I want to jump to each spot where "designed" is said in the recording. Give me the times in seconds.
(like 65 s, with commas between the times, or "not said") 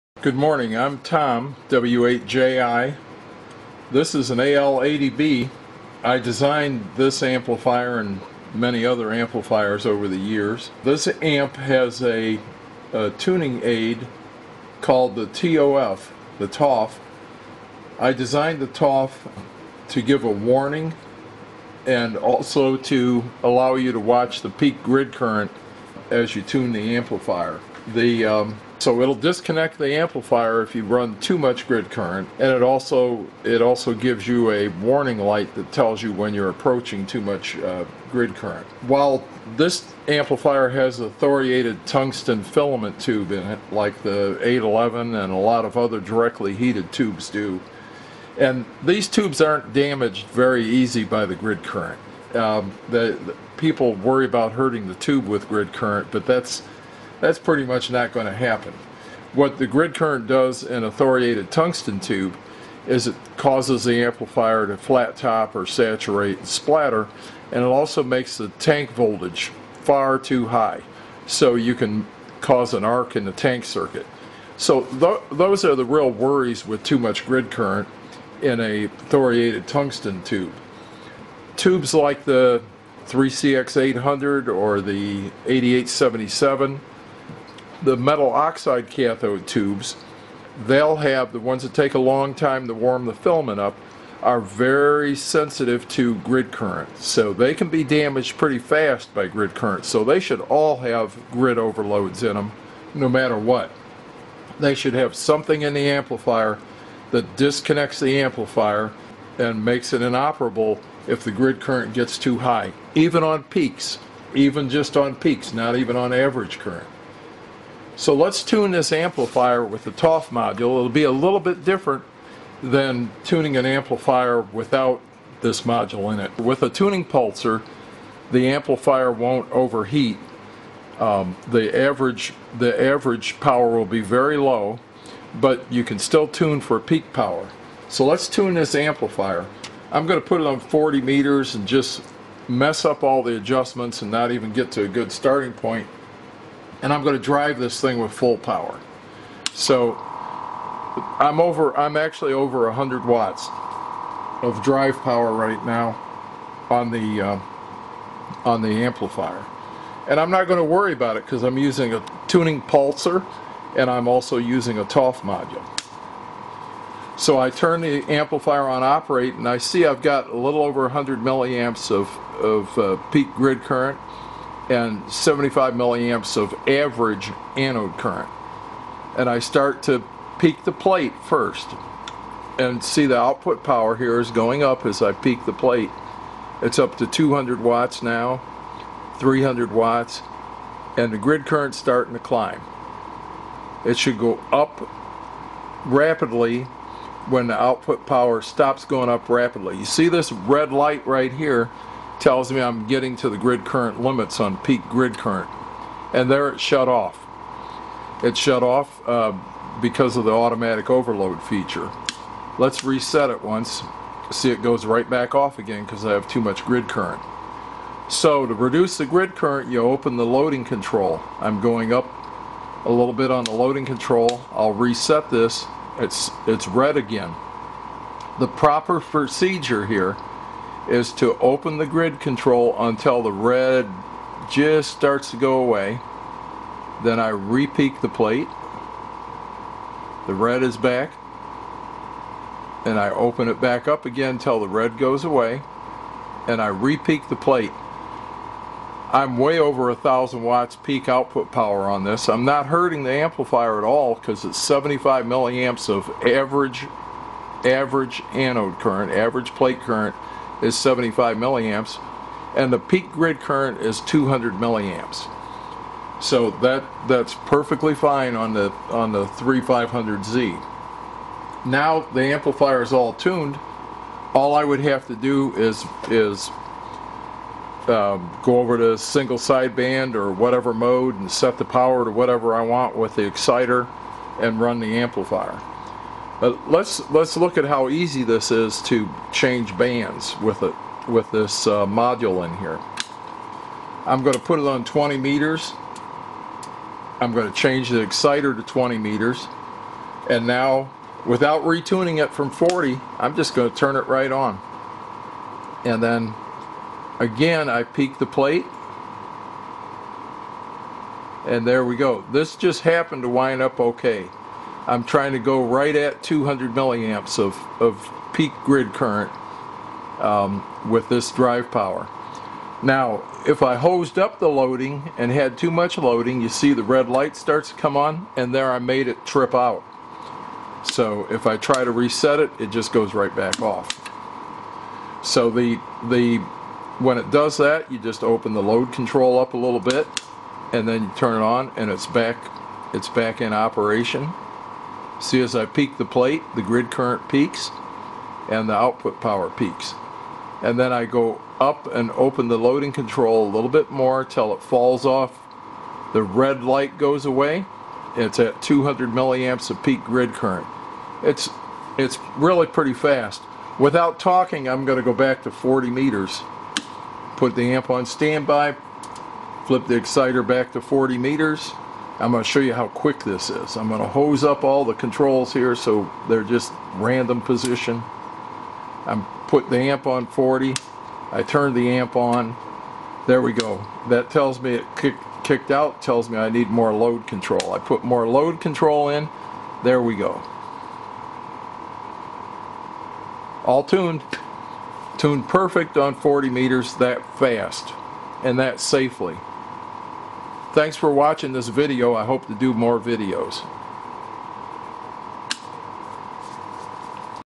6 s, 18 s.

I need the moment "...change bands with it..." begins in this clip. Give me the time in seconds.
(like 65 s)
289 s.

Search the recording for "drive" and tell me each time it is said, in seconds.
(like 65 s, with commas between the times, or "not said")
147 s, 154 s, 321 s.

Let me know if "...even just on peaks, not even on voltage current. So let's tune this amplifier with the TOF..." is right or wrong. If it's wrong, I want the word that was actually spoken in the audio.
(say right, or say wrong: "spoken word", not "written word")
wrong: "average", not "voltage".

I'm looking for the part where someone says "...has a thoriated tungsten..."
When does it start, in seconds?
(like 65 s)
40 s.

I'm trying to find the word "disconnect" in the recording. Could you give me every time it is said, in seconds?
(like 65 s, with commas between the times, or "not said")
29 s, 107 s.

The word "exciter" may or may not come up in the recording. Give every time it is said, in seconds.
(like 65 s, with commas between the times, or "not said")
283 s, 298 s, 369 s.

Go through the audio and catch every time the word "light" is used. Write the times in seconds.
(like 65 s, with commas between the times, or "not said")
35 s, 200 s, 327 s, 356 s.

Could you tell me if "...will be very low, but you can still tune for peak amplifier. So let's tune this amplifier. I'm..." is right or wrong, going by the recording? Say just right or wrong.
wrong.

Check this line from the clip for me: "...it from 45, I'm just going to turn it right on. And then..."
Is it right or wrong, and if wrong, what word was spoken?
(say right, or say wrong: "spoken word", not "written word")
wrong: "40", not "45".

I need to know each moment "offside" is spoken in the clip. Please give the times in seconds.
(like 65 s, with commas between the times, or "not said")
not said.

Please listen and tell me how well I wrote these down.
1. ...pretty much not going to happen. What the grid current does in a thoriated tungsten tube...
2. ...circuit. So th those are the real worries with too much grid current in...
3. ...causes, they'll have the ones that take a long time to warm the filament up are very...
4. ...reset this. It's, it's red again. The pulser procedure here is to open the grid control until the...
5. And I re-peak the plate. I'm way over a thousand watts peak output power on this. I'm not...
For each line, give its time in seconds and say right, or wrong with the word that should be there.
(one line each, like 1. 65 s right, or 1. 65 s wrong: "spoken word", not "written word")
1. 57 s right
2. 73 s right
3. 89 s wrong: "tubes", not "causes"
4. 224 s wrong: "proper", not "pulser"
5. 246 s right.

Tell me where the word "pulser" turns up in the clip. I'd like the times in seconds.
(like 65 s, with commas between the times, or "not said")
127 s, 162 s.